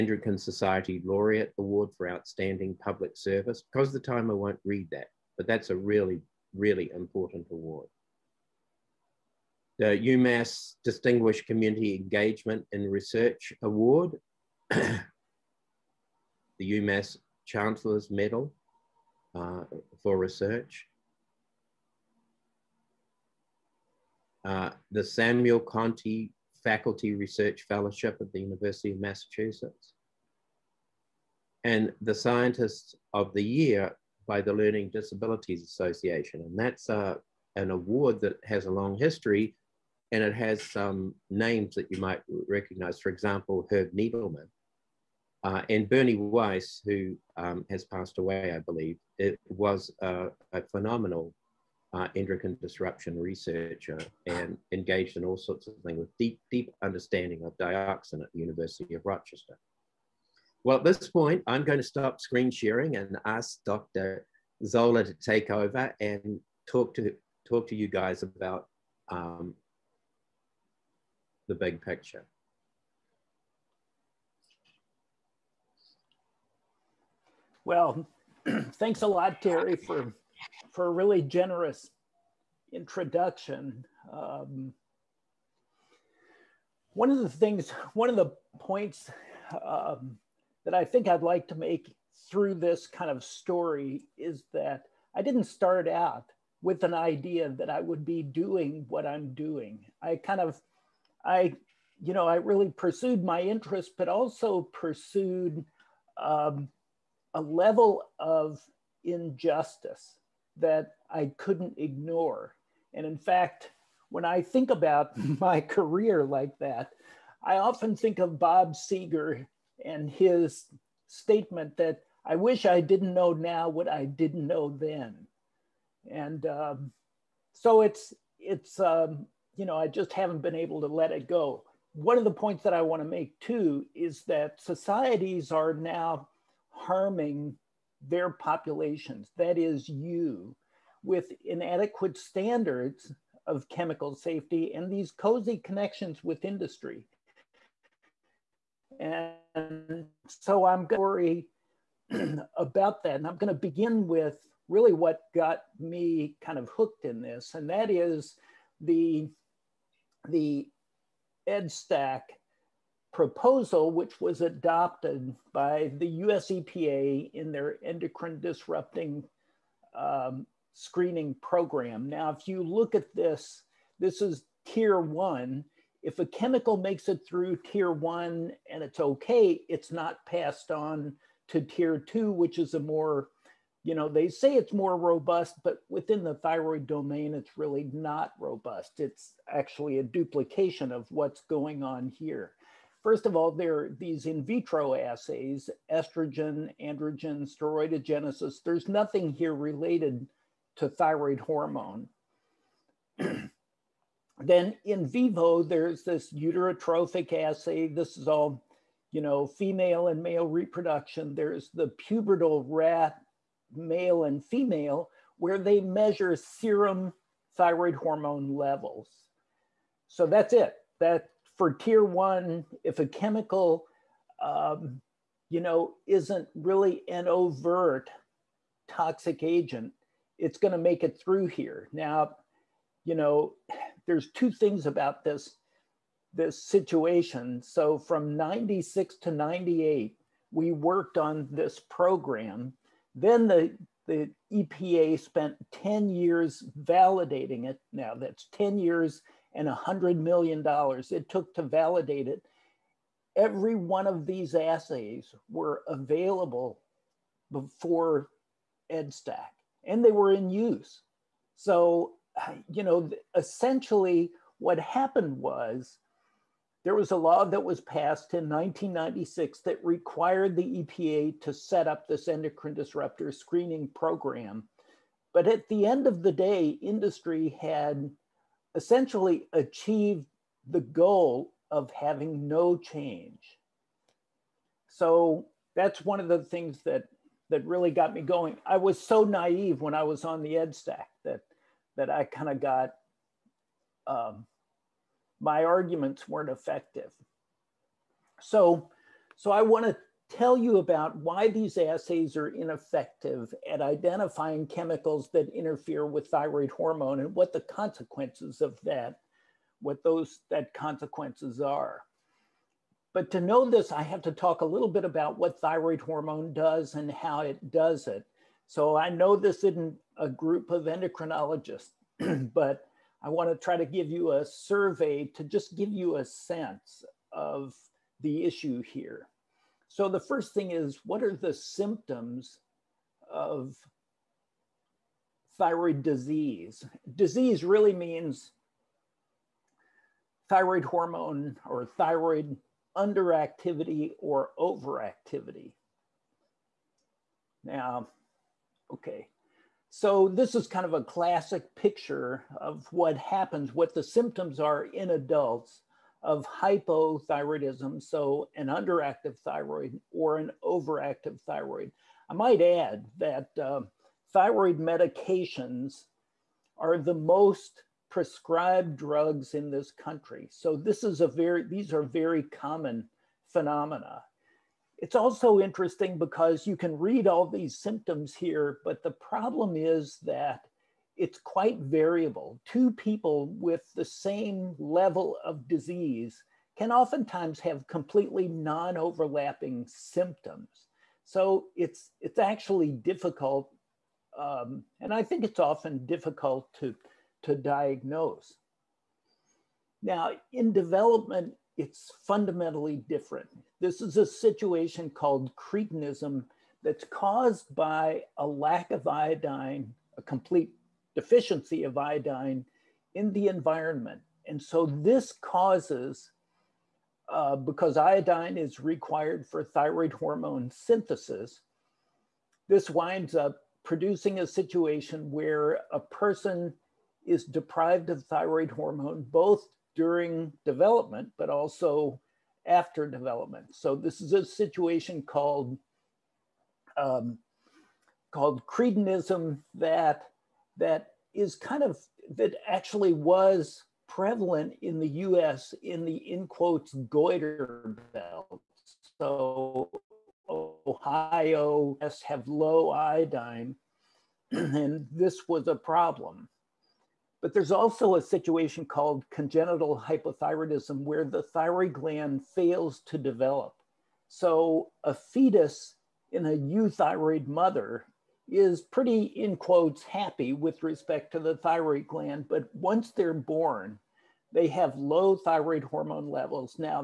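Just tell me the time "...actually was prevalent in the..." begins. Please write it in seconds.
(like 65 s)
442 s.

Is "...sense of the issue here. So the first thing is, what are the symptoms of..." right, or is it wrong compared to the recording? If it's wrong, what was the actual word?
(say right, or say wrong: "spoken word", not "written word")
right.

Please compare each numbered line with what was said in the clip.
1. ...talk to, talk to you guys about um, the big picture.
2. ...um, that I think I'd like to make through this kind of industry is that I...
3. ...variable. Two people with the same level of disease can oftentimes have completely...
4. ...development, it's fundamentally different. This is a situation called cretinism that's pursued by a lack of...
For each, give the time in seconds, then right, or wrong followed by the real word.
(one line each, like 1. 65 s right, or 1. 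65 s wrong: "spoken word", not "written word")
1. 66 s right
2. 89 s wrong: "story", not "industry"
3. 381 s right
4. 400 s wrong: "caused", not "pursued".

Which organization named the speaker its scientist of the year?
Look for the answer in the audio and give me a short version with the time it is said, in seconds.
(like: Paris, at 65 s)
Learning Disabilities Association, at 34 s.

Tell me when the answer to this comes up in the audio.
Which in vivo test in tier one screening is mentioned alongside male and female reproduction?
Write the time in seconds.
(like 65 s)
206 s.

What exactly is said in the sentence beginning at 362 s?
I might add that uh, thyroid medications are the most prescribed drugs in this country.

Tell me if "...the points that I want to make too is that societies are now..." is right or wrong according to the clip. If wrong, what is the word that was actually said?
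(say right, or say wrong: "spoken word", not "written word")
right.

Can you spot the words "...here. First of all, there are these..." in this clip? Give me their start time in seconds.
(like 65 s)
192 s.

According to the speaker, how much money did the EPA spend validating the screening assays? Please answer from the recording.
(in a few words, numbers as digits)
$100 million.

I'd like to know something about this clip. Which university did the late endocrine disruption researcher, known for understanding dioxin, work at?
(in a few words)
University of Rochester.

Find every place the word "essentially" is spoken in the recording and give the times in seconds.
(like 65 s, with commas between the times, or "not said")
263 s, 278 s.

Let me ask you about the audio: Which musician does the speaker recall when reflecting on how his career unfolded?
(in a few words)
Bob Seeger.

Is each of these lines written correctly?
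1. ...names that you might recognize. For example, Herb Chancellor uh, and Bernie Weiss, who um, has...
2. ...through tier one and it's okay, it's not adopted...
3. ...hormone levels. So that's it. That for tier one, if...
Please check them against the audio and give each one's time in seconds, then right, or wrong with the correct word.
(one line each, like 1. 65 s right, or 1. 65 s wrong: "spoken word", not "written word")
1. 41 s wrong: "Needleman", not "Chancellor"
2. 177 s wrong: "passed", not "adopted"
3. 217 s right.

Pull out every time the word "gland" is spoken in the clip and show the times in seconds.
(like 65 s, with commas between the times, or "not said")
461 s, 472 s.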